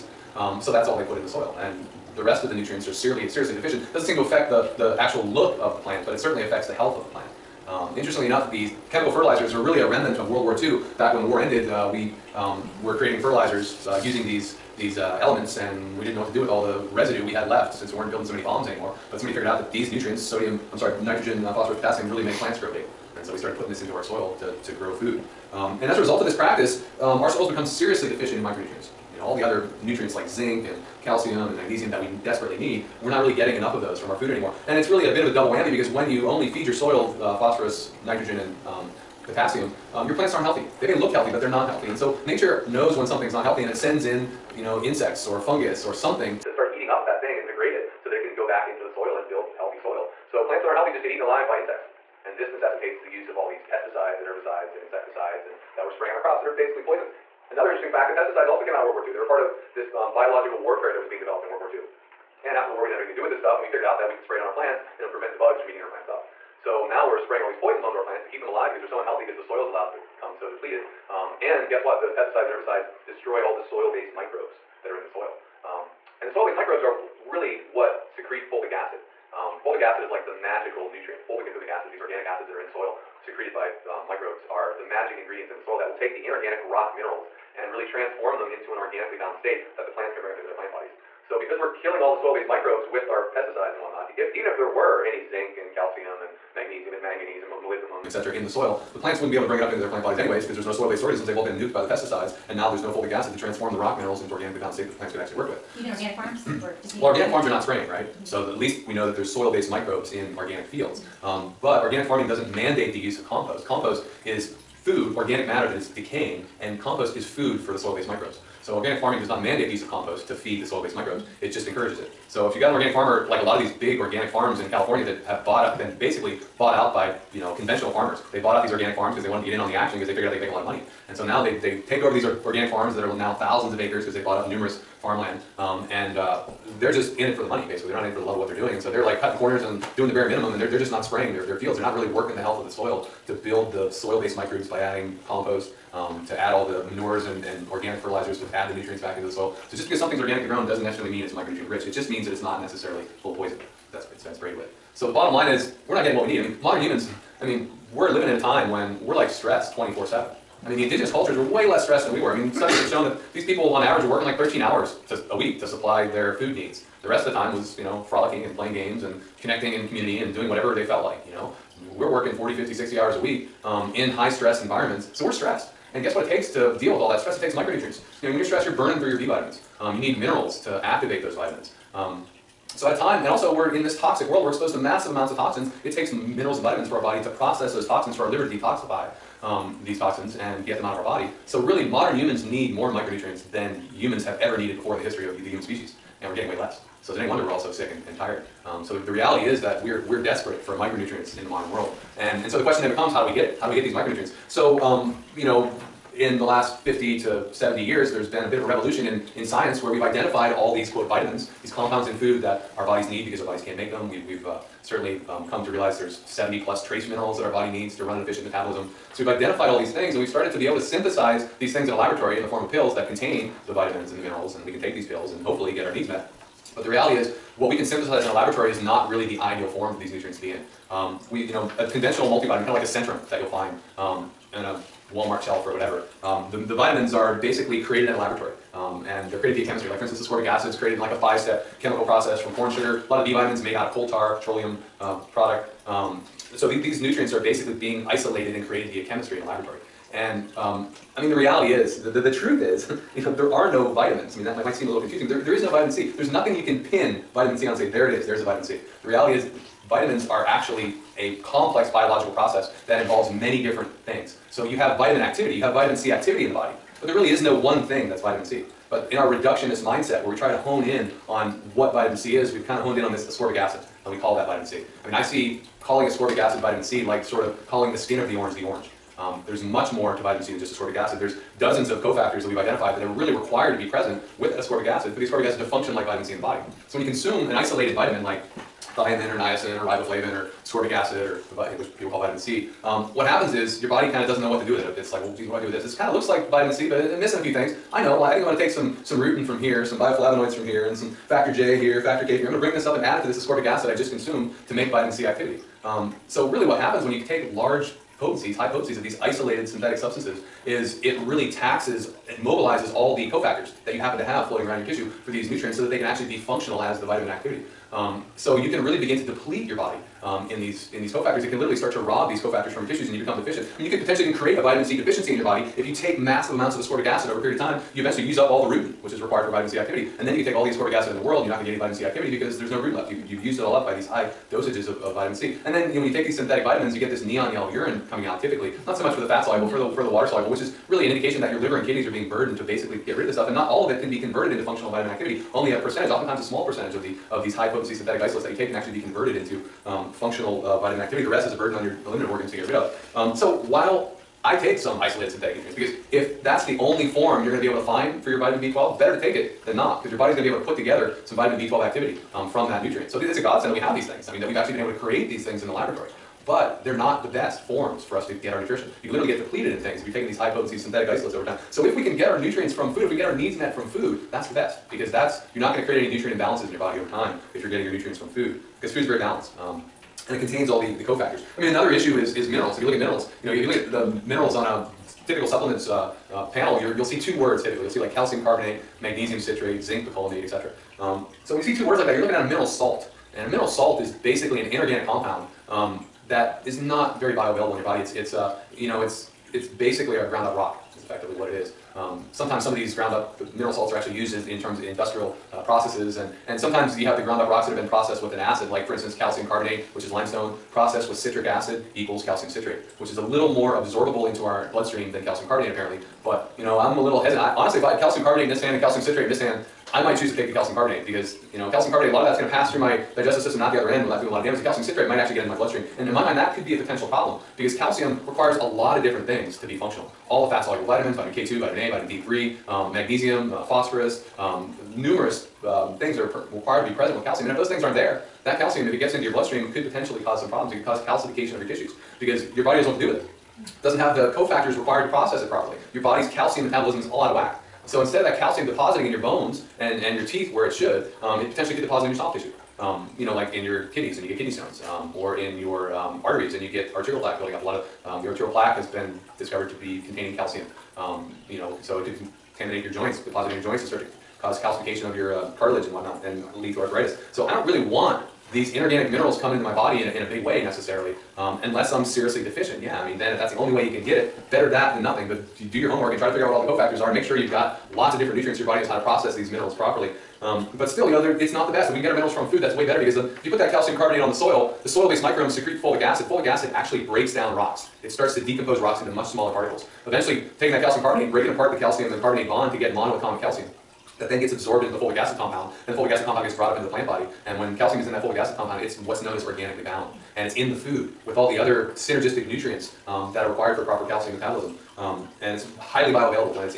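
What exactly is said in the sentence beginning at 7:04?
The calcium citrate might actually get into my bloodstream.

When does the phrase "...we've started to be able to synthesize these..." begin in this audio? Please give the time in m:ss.
3:40.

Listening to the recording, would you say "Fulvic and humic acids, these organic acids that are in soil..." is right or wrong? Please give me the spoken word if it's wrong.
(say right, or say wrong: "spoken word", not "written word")
right.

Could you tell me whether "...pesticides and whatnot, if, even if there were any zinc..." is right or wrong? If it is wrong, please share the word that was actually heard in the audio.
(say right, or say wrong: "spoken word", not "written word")
right.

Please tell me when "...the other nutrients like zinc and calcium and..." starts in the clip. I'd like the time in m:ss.
0:29.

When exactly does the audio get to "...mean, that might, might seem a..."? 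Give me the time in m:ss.
4:14.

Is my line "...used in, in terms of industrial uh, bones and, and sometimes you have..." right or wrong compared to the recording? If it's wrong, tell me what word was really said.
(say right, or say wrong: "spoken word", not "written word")
wrong: "processes", not "bones".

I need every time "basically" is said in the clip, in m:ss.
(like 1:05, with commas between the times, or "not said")
0:56, 2:06, 2:17, 3:57, 4:07, 5:42, 6:34, 6:39.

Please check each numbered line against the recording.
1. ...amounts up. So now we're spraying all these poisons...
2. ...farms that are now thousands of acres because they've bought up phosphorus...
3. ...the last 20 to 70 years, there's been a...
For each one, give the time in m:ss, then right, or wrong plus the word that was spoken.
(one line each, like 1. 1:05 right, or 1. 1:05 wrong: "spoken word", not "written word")
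1. 1:05 wrong: "plants", not "amounts"
2. 2:12 wrong: "numerous", not "phosphorus"
3. 3:26 wrong: "50", not "20".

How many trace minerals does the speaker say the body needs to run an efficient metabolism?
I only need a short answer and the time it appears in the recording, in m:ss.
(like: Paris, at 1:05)
70 plus, at 3:36.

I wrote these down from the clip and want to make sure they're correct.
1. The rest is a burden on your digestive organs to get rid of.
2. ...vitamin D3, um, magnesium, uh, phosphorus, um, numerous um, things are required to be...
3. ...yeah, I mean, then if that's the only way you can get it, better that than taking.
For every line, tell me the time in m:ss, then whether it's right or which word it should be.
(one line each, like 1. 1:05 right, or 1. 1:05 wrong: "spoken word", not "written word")
1. 5:51 wrong: "eliminative", not "digestive"
2. 7:11 right
3. 7:52 wrong: "nothing", not "taking".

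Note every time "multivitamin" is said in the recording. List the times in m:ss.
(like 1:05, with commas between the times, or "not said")
3:52.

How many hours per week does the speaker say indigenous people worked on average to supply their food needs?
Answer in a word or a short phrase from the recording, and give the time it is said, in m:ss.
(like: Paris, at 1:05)
13, at 2:44.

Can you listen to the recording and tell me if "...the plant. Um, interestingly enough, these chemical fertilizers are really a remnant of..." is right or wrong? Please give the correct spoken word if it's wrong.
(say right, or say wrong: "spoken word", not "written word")
right.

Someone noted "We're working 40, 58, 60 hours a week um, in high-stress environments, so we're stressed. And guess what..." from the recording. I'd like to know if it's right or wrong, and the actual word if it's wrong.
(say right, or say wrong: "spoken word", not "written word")
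wrong: "50", not "58".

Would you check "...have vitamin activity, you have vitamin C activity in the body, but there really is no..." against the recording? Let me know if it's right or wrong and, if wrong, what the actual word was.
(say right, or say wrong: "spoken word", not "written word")
right.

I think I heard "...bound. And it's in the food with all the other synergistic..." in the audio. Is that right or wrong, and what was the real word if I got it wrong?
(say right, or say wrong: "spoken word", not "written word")
right.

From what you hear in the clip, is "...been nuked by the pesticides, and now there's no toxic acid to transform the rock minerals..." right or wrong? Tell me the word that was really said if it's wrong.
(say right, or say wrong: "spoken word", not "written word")
wrong: "fulvic", not "toxic".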